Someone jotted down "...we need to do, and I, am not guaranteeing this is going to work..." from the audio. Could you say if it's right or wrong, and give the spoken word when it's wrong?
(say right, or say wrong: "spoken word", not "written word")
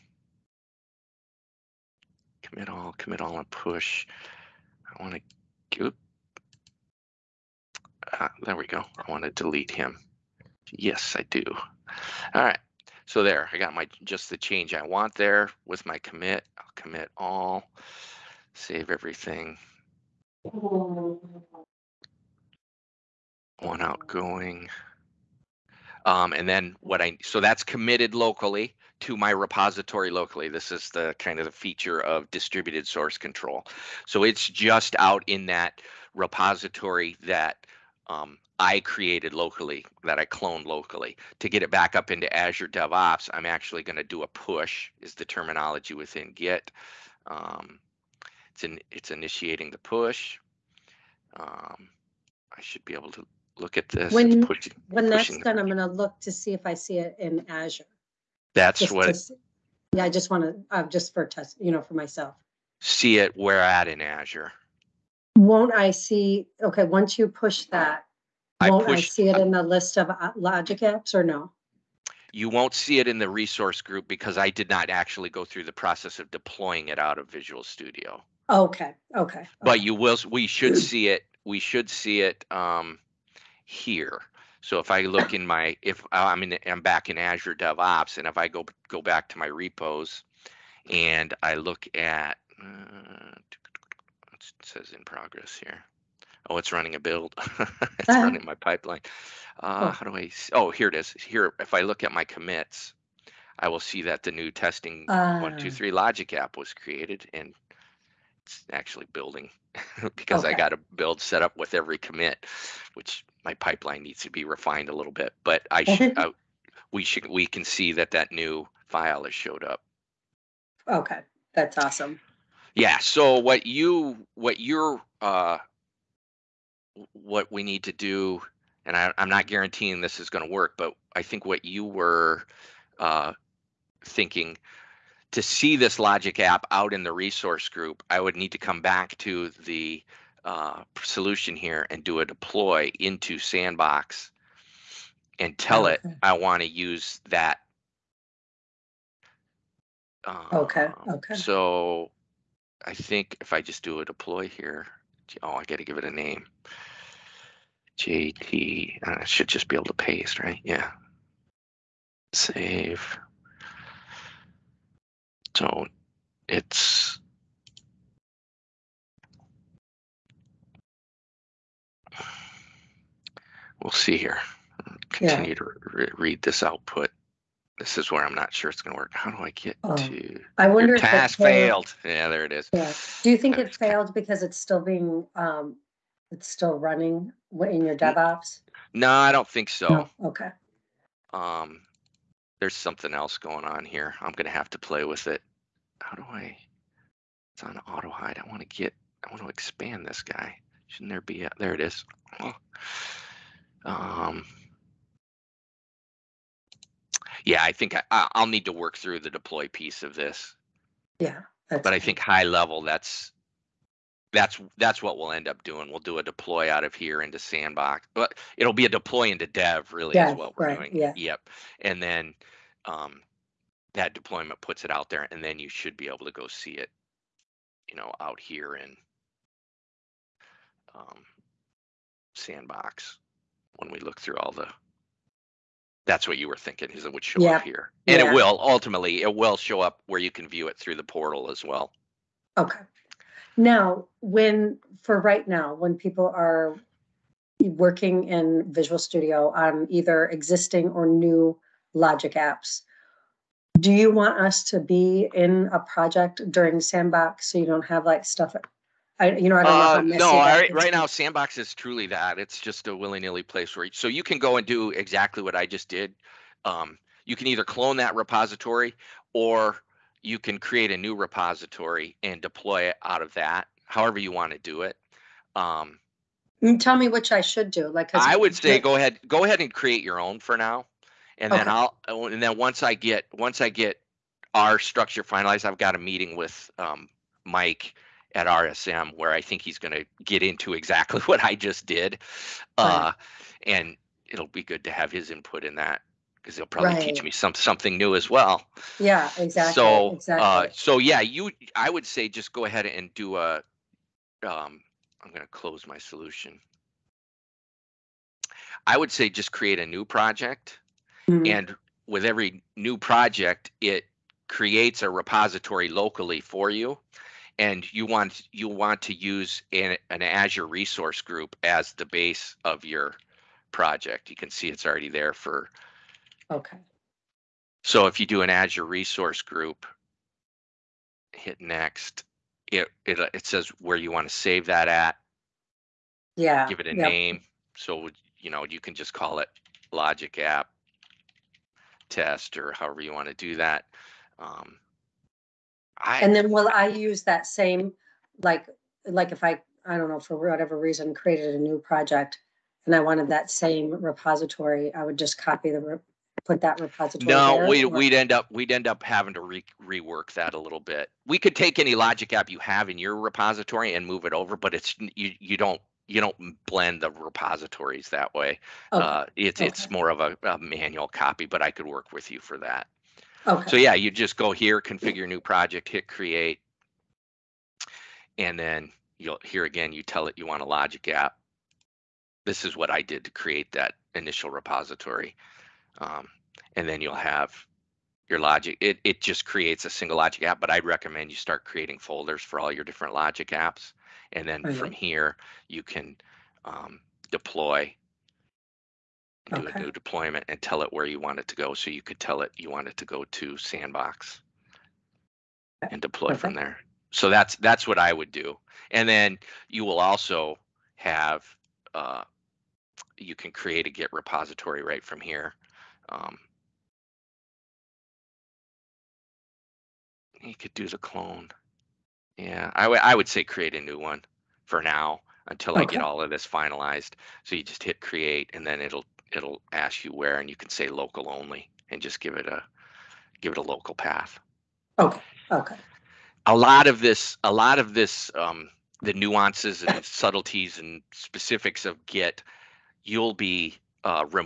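right.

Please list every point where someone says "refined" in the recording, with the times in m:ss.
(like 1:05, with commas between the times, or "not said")
1:54.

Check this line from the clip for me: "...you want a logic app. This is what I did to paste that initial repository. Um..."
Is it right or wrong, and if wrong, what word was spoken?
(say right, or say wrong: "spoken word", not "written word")
wrong: "create", not "paste".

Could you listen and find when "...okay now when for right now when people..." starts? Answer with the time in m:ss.
4:02.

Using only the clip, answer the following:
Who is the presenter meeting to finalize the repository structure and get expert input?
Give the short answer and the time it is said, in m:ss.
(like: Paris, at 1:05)
Mike, at 4:47.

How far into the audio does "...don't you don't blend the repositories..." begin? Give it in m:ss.
6:05.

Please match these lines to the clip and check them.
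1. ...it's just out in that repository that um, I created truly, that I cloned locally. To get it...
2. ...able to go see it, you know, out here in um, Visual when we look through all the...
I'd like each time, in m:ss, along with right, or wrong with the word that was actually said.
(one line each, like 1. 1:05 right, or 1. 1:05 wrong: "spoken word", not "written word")
1. 0:34 wrong: "locally", not "truly"
2. 3:46 wrong: "Sandbox", not "Visual".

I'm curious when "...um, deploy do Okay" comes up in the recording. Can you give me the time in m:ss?
6:36.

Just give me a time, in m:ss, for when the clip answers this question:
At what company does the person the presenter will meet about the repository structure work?
4:48.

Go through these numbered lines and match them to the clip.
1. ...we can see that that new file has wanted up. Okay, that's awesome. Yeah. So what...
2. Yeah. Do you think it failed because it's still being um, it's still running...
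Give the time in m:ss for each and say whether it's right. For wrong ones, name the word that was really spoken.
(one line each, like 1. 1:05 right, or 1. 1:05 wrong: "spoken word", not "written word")
1. 1:57 wrong: "showed", not "wanted"
2. 3:02 right.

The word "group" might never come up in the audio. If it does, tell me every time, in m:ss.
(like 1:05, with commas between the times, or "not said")
1:13, 2:17, 5:21, 5:29.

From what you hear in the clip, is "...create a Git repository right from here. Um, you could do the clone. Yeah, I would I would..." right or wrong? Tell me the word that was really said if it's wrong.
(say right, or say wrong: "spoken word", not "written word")
right.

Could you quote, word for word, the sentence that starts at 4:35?
Um, mm, Tell me which I should do.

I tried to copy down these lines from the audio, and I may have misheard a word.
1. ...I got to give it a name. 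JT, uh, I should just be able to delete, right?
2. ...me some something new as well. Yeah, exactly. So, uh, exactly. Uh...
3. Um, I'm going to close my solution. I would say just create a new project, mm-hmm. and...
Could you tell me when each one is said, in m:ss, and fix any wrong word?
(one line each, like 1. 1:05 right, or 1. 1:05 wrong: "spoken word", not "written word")
1. 2:35 wrong: "paste", not "delete"
2. 4:57 right
3. 5:04 right.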